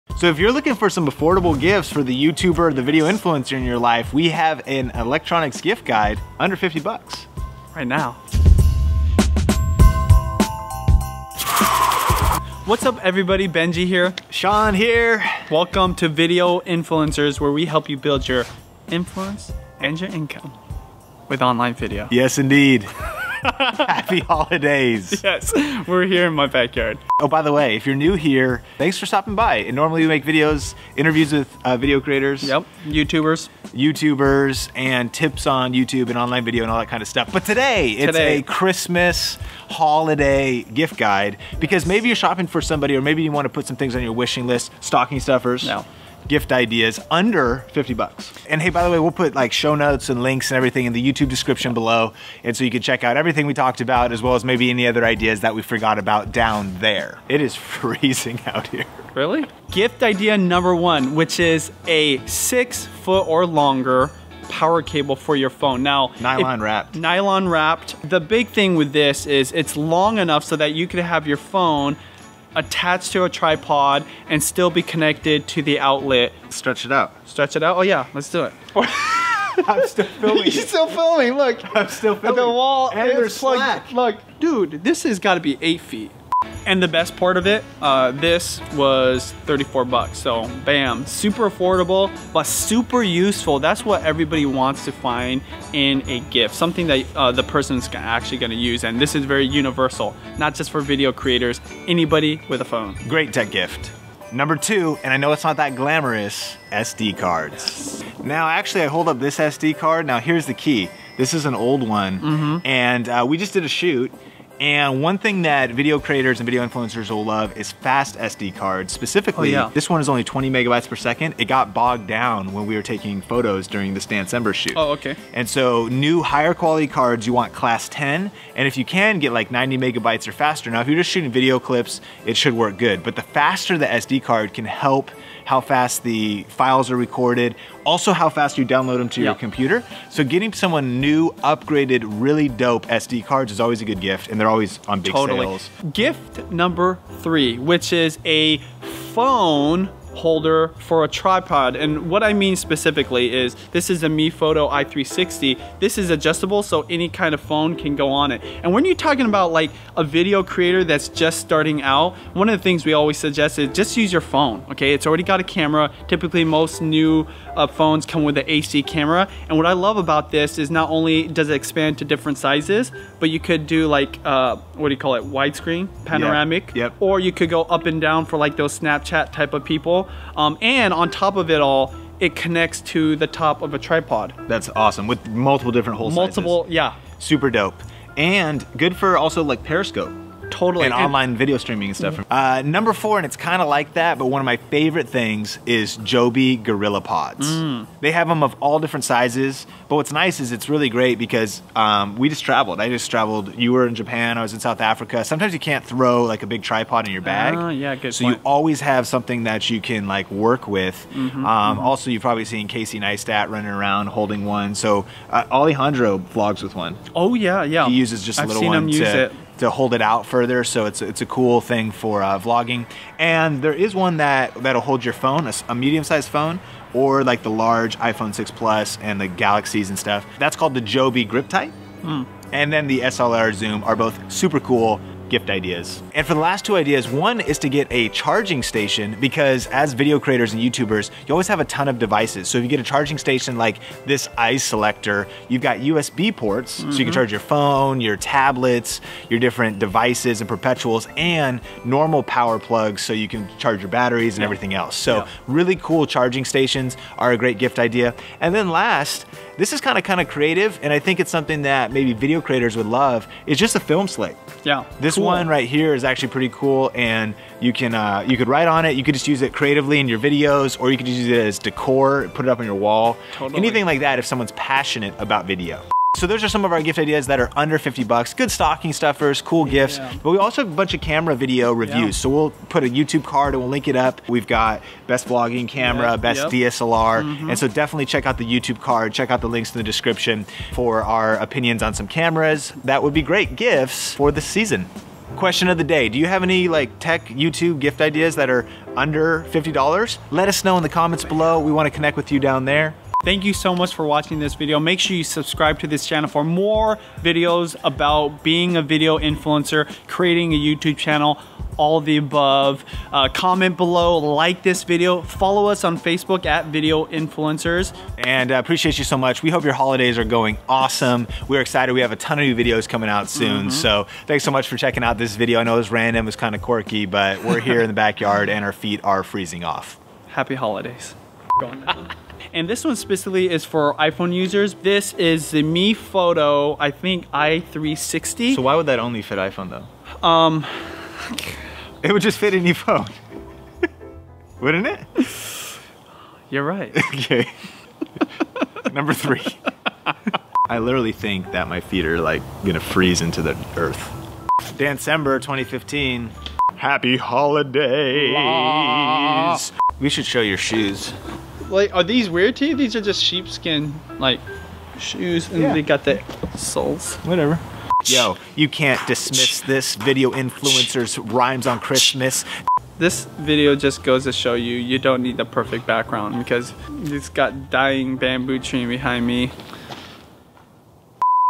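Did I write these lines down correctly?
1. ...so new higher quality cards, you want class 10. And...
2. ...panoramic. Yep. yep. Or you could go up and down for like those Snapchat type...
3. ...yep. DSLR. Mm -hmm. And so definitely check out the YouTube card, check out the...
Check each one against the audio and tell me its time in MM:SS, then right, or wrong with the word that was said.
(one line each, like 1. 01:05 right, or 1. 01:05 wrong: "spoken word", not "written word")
1. 02:05 right
2. 02:56 right
3. 04:46 right.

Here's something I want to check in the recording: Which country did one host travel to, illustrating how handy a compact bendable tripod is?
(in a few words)
South Africa.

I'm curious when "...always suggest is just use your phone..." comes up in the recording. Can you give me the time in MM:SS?
02:42.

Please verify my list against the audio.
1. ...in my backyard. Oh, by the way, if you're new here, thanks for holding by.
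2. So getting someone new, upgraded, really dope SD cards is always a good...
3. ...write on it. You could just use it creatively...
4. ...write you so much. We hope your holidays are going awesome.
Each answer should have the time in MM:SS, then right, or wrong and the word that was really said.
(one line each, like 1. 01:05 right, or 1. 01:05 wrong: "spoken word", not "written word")
1. 00:26 wrong: "stopping", not "holding"
2. 02:20 right
3. 04:28 right
4. 05:18 wrong: "appreciate", not "write".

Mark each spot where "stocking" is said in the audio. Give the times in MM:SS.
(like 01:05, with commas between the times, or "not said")
00:44, 04:38.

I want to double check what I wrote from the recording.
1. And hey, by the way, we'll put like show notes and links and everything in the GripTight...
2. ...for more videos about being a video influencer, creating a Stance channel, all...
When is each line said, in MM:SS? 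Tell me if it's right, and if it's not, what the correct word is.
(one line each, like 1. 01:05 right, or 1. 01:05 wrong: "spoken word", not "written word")
1. 00:48 wrong: "YouTube", not "GripTight"
2. 05:06 wrong: "YouTube", not "Stance".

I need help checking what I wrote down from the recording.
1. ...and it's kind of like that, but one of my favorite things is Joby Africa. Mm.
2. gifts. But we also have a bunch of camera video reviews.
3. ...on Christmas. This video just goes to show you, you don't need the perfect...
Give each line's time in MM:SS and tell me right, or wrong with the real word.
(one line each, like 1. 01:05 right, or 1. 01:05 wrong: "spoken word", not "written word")
1. 03:13 wrong: "GorillaPods", not "Africa"
2. 04:39 right
3. 06:11 right.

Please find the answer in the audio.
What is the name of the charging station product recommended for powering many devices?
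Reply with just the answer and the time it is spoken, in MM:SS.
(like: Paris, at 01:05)
iSelector, at 04:04.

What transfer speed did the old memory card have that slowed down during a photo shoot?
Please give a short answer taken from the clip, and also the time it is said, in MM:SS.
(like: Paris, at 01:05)
20 megabytes per second, at 02:00.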